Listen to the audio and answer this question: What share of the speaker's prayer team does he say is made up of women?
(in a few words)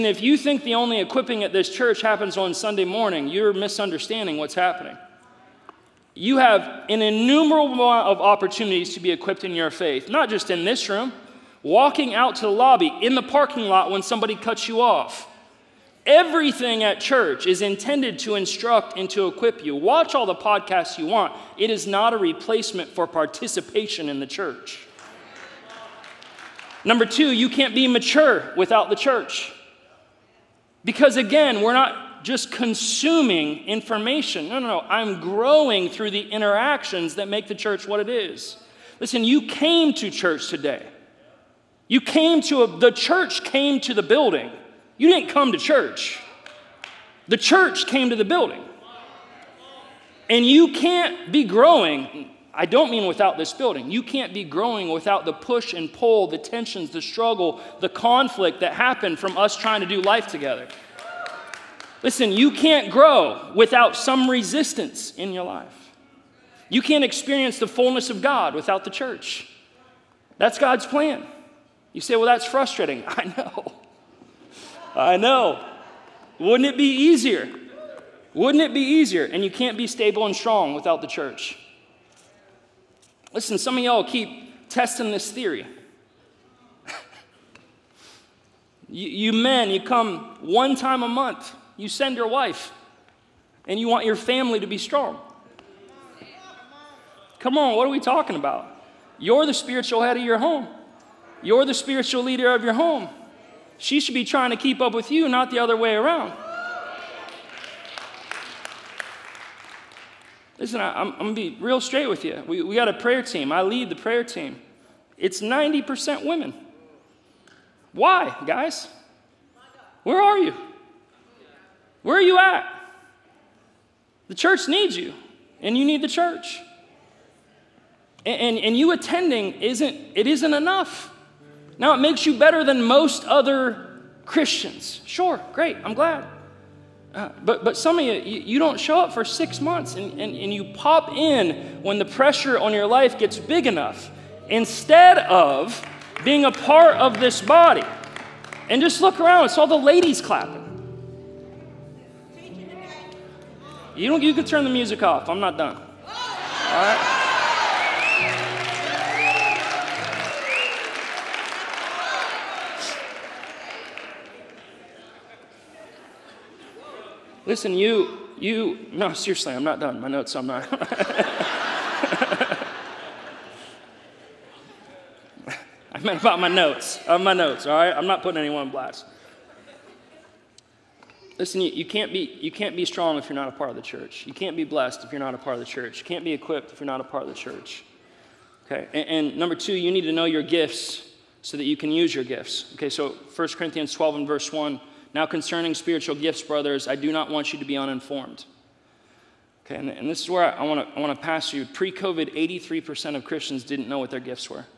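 90%.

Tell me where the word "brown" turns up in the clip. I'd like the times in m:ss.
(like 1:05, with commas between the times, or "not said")
not said.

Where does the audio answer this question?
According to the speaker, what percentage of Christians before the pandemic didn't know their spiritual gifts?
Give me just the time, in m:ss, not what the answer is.
3:22.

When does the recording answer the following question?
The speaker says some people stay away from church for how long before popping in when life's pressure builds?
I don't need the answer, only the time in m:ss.
2:19.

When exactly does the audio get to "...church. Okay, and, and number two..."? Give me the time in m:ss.
3:07.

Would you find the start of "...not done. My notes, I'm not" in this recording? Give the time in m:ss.
2:49.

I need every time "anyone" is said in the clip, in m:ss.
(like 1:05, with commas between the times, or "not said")
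2:58.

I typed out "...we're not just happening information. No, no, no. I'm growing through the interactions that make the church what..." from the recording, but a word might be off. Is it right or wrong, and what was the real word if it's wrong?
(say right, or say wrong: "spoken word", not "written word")
wrong: "consuming", not "happening".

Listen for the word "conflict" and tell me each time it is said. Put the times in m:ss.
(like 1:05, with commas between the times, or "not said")
0:57.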